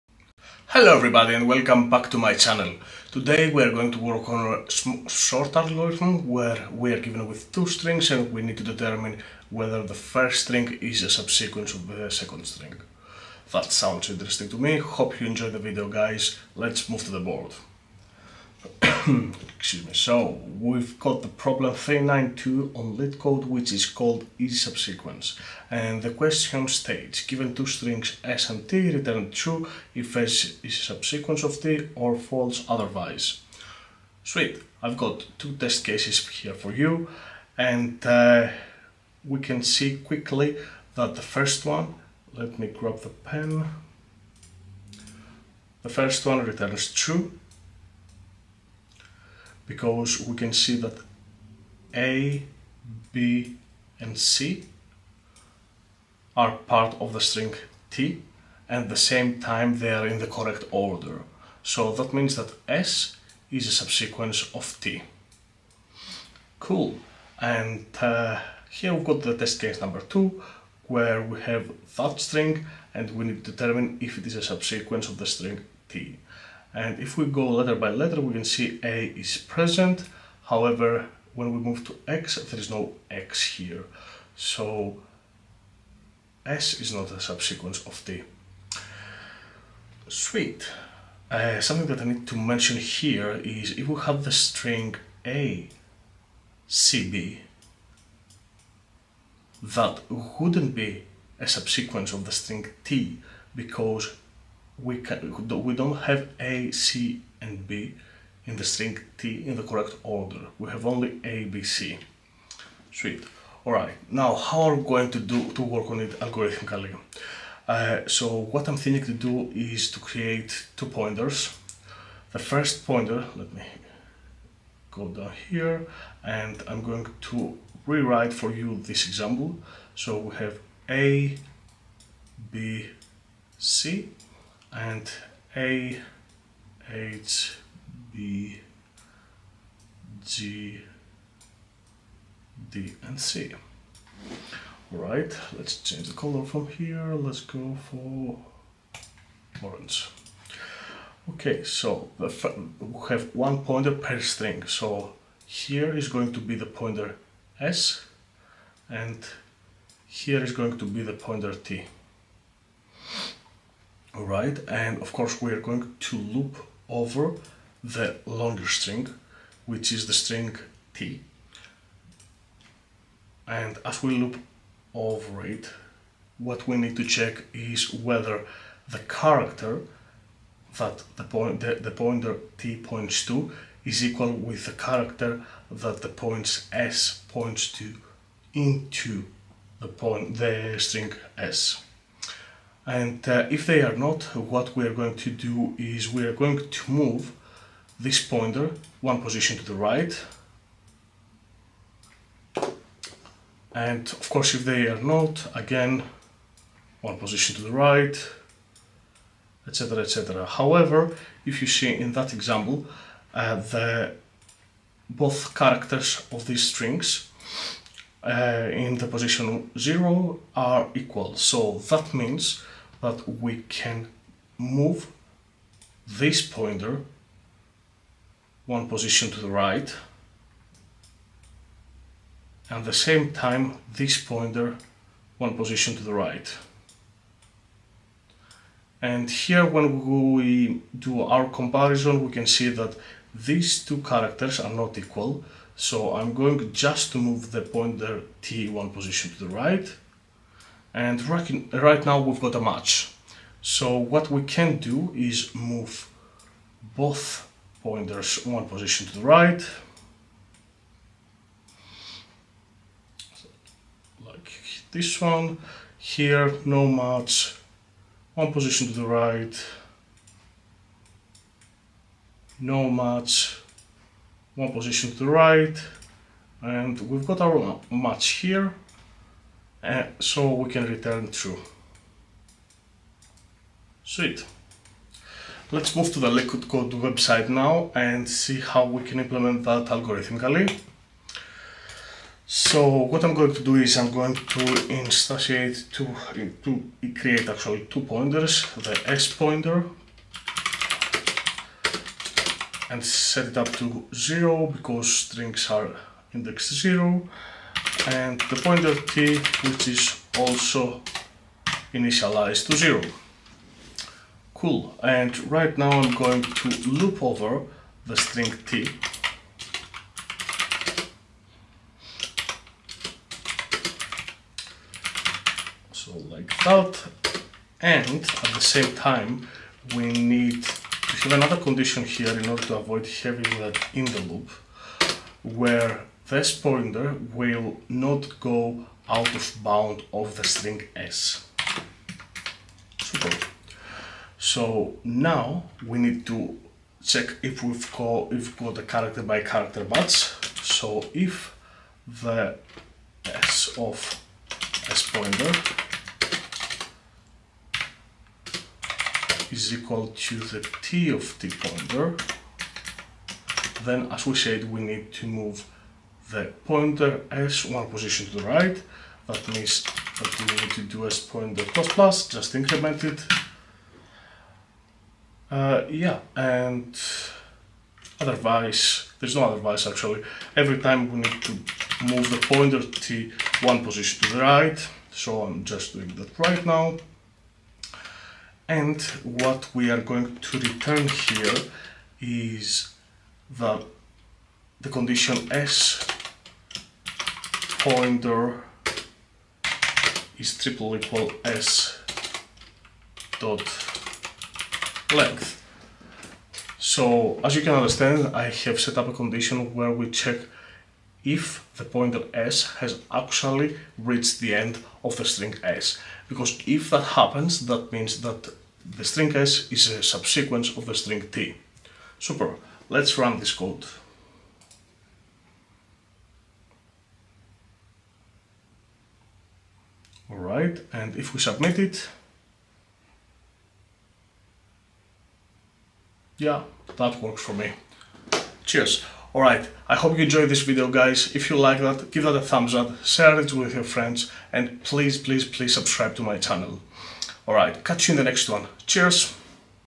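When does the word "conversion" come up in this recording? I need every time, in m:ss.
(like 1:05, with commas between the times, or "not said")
not said.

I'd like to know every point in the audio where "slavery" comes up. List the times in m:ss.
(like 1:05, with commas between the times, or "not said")
not said.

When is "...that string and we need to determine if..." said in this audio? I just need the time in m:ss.
1:11.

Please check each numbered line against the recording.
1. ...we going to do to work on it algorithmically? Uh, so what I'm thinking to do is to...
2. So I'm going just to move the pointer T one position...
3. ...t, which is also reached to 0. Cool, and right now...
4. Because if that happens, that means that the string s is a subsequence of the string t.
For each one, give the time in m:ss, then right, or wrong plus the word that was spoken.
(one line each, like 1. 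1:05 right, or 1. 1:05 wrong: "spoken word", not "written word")
1. 1:54 right
2. 4:05 right
3. 5:08 wrong: "initialized", not "reached"
4. 6:56 right.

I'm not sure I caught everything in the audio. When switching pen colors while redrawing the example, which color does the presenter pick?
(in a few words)
orange.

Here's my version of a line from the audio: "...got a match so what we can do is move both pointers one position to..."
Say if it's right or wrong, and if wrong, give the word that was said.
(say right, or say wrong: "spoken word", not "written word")
right.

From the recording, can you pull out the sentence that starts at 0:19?
So we've got the problem 392 on LeetCode which is called is subsequence.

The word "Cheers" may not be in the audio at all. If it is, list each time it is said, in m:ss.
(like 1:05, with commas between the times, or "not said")
7:18, 7:28.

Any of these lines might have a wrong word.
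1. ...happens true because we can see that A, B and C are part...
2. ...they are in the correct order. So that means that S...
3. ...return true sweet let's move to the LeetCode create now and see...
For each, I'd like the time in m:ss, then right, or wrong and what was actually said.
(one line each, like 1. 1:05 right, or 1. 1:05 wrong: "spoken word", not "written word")
1. 0:46 wrong: "returns", not "happens"
2. 0:59 right
3. 4:40 wrong: "website", not "create".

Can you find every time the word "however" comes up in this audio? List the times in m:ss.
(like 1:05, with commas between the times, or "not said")
1:20, 3:30.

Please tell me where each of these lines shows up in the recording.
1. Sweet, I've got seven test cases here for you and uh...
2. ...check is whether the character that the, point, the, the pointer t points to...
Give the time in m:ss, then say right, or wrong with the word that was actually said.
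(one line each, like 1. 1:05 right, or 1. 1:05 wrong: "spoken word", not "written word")
1. 0:34 wrong: "two", not "seven"
2. 2:57 right.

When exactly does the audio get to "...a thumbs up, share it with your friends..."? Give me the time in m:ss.
7:22.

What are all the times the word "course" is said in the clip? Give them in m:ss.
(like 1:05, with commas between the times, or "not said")
2:45, 3:24.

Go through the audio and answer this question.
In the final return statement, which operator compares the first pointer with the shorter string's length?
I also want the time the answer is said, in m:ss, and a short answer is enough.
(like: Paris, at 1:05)
triple equal, at 6:40.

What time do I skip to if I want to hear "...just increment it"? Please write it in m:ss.
6:12.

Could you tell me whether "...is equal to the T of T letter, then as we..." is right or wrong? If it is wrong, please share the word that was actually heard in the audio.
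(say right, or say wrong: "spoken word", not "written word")
wrong: "pointer", not "letter".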